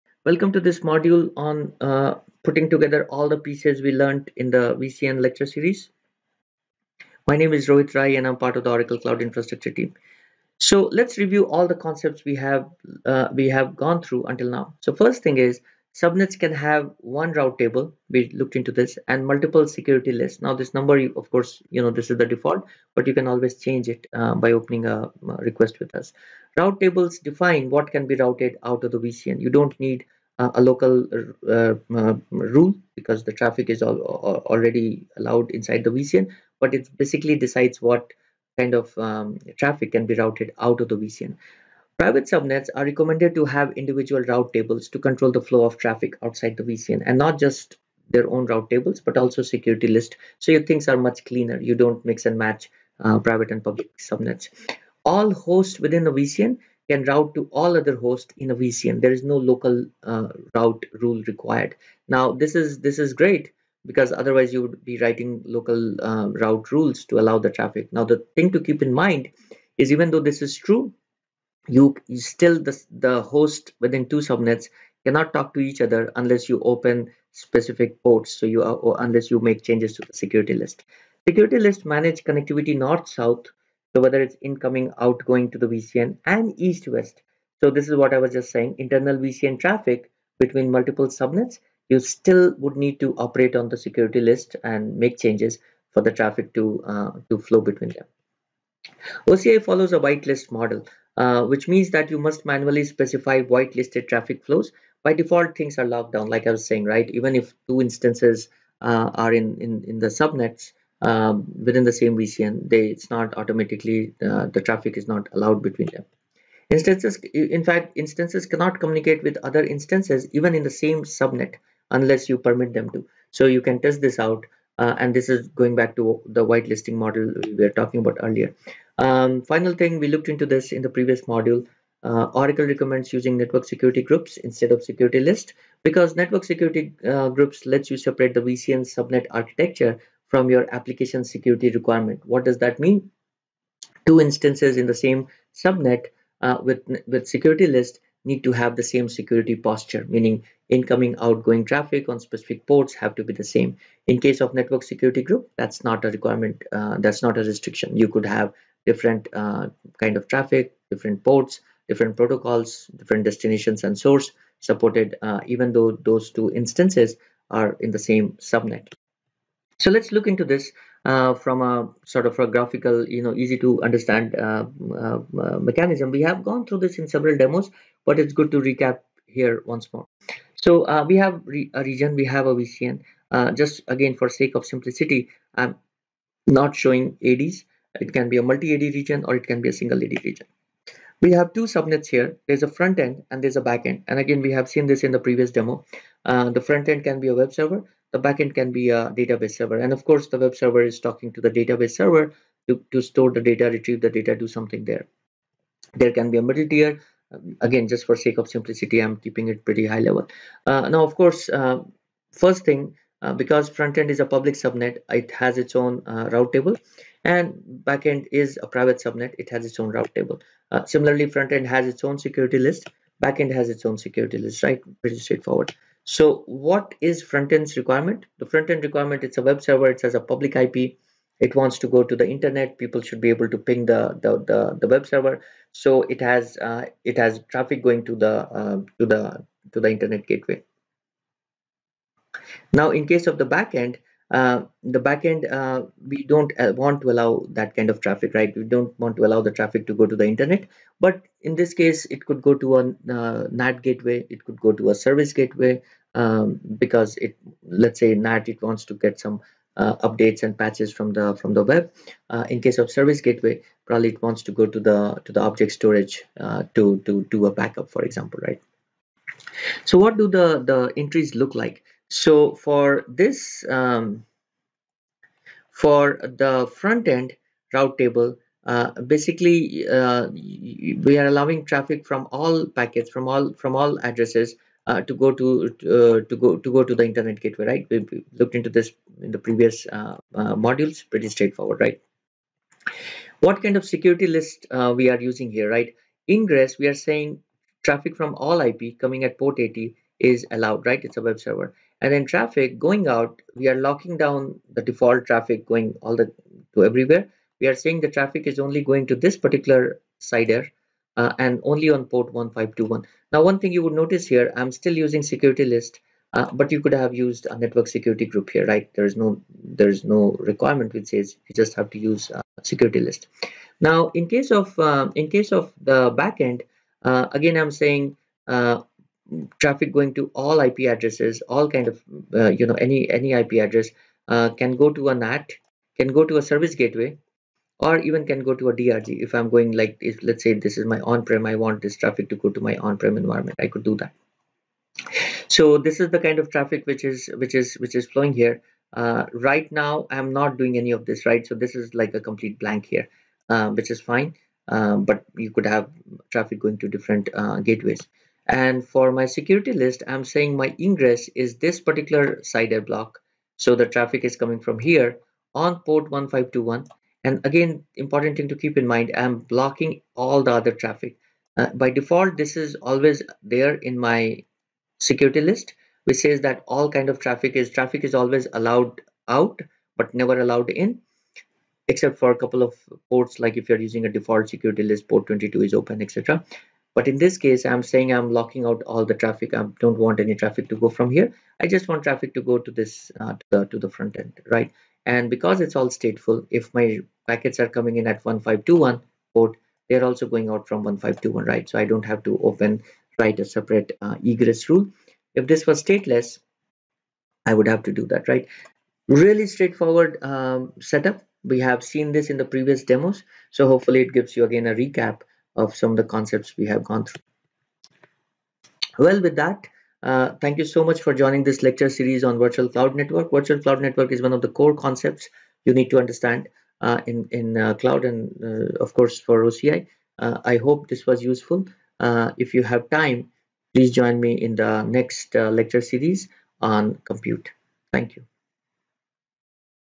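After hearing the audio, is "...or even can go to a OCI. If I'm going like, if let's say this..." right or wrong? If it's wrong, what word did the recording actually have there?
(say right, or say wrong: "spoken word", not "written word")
wrong: "DRG", not "OCI".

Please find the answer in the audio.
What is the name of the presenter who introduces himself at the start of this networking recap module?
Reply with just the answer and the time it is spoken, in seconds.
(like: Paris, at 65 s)
Rohit Rai, at 7 s.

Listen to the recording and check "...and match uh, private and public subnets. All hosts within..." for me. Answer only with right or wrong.
right.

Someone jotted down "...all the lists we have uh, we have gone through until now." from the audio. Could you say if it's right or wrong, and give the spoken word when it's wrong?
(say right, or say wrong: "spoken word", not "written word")
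wrong: "concepts", not "lists".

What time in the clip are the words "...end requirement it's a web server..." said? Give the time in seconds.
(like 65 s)
228 s.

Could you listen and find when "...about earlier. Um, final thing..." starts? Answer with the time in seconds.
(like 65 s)
127 s.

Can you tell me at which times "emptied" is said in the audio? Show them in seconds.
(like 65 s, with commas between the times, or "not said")
not said.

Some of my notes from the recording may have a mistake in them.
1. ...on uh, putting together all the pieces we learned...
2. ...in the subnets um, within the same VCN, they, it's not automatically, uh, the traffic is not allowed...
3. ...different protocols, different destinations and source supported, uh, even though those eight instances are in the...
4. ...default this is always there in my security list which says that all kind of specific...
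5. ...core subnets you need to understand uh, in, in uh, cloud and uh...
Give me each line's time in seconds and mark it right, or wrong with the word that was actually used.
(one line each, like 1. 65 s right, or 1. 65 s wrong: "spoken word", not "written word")
1. 1 s right
2. 109 s right
3. 161 s wrong: "two", not "eight"
4. 371 s wrong: "traffic", not "specific"
5. 424 s wrong: "concepts", not "subnets".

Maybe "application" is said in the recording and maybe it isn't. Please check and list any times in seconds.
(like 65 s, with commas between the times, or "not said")
140 s.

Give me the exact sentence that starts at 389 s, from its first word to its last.
I don't want any traffic to go from here.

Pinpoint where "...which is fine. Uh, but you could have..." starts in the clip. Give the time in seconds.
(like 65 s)
353 s.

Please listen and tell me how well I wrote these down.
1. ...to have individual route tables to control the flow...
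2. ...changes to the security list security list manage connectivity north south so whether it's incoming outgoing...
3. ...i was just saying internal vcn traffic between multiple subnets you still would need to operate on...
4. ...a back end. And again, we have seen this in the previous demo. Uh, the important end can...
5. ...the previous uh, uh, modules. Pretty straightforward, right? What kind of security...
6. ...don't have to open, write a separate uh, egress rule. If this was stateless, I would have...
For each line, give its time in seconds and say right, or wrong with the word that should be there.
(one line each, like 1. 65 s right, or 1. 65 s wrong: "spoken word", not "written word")
1. 43 s right
2. 79 s right
3. 88 s right
4. 193 s wrong: "front", not "important"
5. 289 s right
6. 401 s right.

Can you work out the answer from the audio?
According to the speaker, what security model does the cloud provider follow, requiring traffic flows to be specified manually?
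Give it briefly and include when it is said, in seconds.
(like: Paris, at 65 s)
whitelist model, at 100 s.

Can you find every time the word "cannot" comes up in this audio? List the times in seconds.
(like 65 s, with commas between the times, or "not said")
75 s, 118 s.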